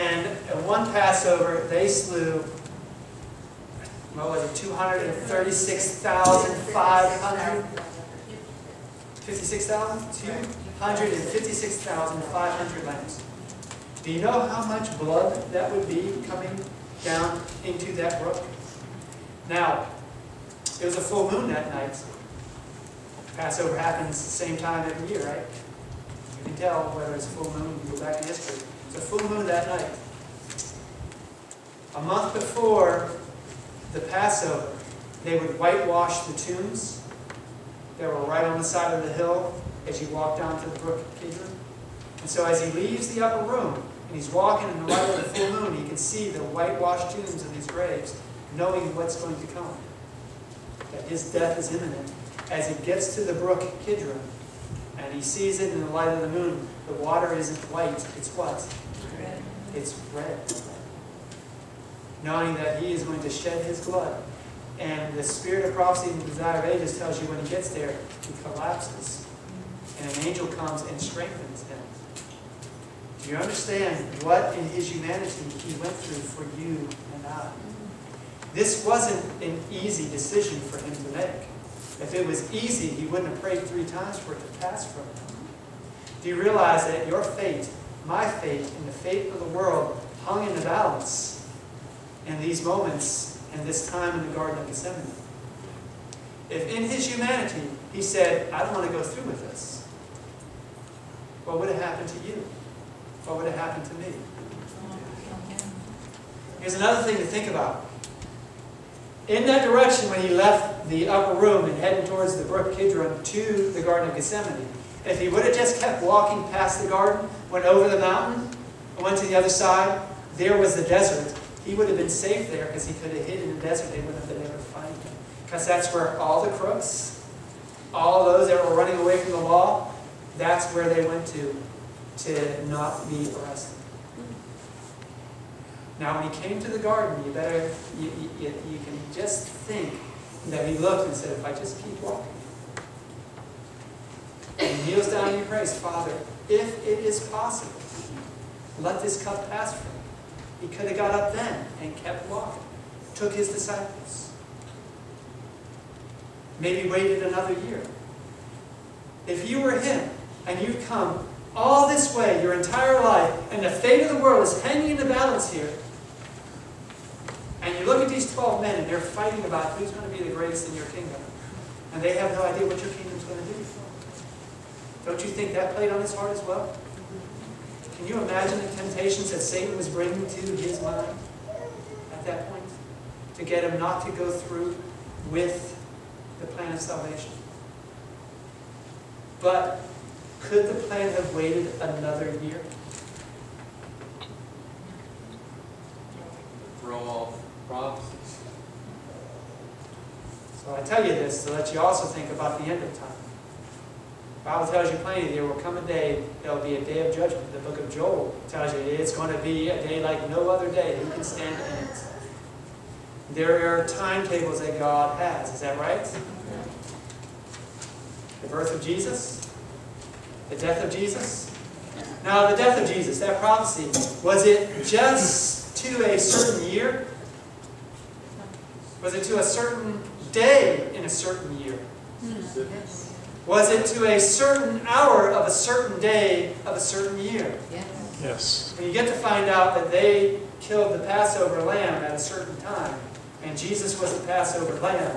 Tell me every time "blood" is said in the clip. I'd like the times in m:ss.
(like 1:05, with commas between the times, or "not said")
0:14, 1:03.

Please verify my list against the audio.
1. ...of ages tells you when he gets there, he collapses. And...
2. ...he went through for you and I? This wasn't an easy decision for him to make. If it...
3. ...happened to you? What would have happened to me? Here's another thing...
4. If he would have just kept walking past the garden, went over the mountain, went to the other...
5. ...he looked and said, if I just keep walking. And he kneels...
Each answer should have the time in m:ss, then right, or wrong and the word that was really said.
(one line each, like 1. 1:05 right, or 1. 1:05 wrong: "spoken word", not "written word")
1. 1:06 right
2. 1:15 right
3. 1:41 right
4. 1:55 right
5. 2:20 right.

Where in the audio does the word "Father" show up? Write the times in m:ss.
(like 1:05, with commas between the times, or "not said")
2:25.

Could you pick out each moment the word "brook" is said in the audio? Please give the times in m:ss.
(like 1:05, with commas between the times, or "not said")
0:18, 0:40, 0:53, 1:52.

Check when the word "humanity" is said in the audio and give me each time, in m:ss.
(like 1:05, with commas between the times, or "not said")
1:14, 1:37.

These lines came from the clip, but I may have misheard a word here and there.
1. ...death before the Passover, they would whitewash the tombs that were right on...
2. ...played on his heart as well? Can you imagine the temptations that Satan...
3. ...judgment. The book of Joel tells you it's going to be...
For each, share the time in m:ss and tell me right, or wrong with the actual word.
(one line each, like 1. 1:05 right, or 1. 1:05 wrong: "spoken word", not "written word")
1. 0:32 wrong: "month", not "death"
2. 2:55 right
3. 3:27 right.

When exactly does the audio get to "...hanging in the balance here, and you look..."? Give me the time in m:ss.
2:44.